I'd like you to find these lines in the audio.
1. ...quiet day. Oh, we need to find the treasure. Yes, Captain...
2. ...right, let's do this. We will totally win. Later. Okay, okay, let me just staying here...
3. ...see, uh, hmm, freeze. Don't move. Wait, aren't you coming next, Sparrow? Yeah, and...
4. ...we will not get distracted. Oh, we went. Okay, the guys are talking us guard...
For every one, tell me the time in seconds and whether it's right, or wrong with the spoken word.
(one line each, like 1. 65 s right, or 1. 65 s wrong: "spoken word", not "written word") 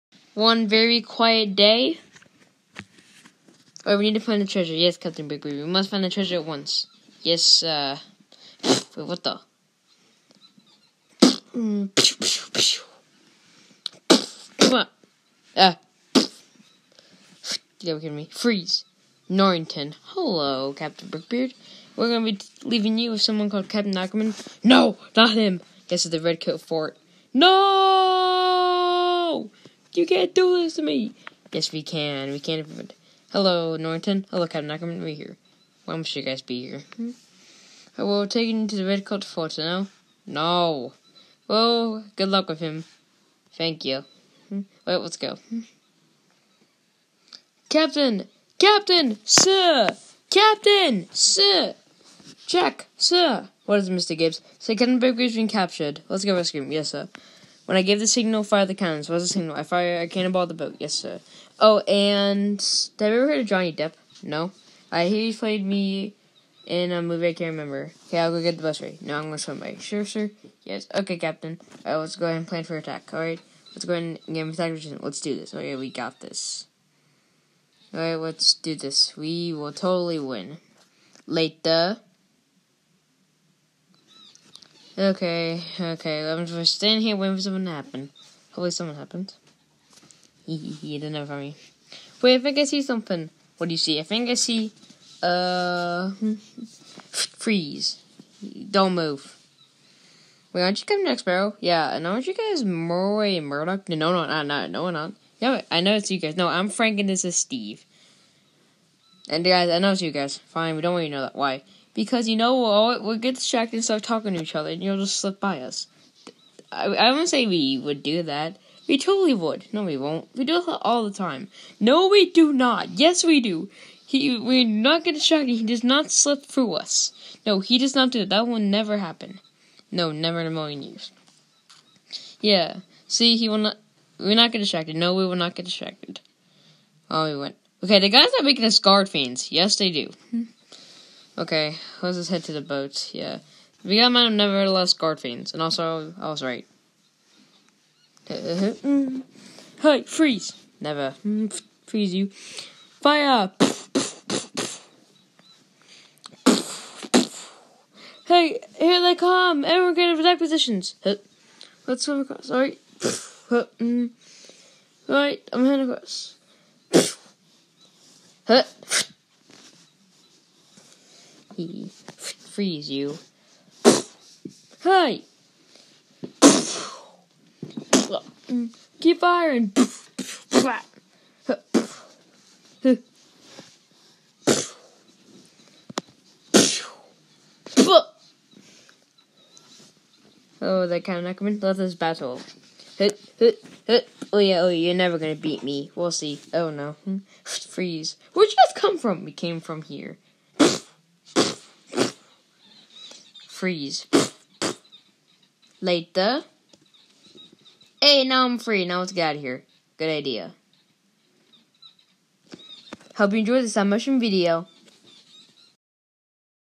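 1. 1 s right
2. 78 s right
3. 94 s right
4. 135 s wrong: "making", not "talking".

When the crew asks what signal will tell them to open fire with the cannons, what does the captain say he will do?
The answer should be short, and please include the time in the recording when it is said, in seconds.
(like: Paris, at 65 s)
Fire a cannonball, at 59 s.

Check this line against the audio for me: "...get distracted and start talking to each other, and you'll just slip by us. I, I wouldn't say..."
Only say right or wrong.
right.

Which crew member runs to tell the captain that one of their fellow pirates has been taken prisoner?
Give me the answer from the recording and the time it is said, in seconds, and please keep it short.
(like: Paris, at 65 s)
Mr. Gibbs, at 53 s.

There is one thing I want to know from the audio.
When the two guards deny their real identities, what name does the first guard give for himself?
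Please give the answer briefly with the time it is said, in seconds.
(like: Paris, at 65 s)
Frank, at 106 s.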